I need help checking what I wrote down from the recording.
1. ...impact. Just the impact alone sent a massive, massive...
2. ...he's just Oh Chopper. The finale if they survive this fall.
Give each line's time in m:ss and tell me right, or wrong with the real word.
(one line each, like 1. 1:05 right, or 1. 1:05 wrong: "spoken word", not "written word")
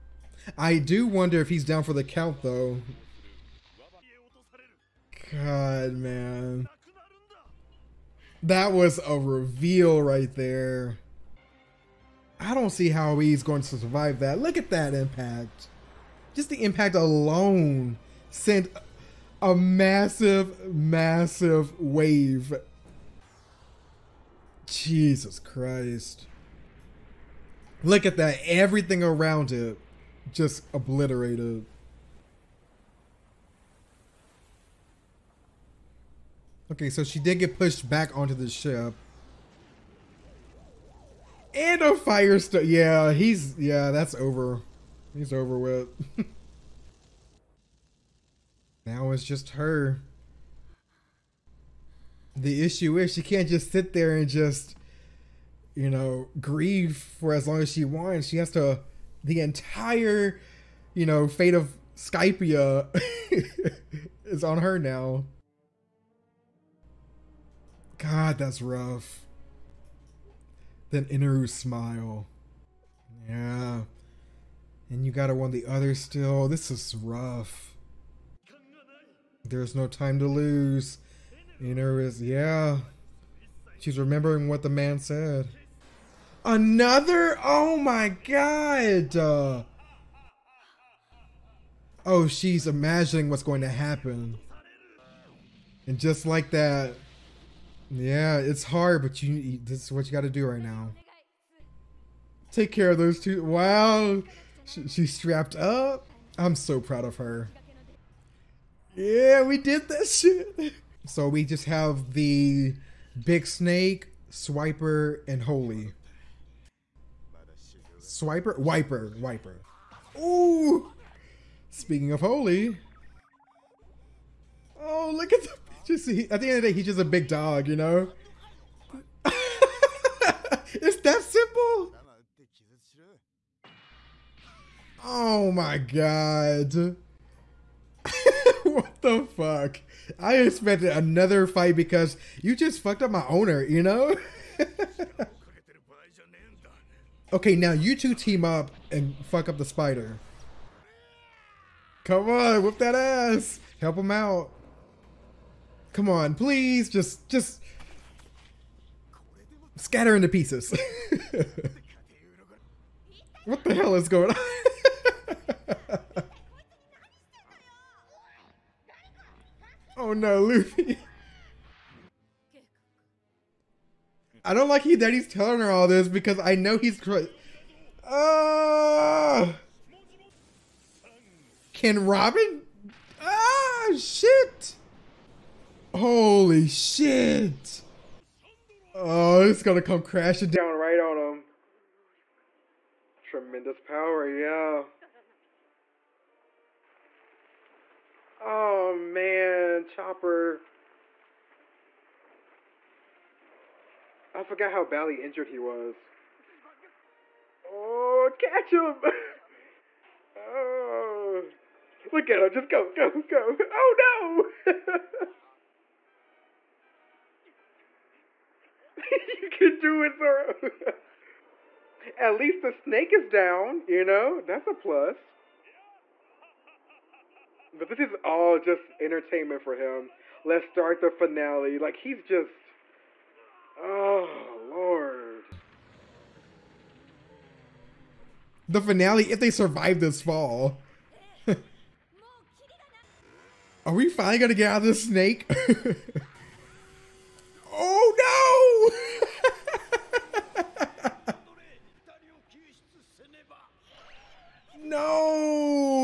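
1. 0:14 right
2. 3:51 wrong: "Lord", not "Chopper".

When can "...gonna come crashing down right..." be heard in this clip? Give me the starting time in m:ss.
3:09.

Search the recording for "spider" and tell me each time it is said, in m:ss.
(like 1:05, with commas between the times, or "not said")
2:29.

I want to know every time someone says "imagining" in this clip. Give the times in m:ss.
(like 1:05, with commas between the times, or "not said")
1:32.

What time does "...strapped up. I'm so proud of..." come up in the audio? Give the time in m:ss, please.
1:45.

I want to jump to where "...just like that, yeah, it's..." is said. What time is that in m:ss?
1:35.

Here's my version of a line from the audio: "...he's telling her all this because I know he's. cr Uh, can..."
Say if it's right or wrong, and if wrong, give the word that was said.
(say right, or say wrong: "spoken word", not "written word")
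right.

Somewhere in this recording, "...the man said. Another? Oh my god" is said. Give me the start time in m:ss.
1:24.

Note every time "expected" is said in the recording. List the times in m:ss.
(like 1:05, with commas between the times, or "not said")
2:20.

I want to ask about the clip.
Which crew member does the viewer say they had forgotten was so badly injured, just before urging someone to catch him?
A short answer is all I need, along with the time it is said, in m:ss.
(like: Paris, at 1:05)
Chopper, at 3:19.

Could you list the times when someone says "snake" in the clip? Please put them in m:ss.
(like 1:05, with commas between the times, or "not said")
1:53, 3:42, 4:05.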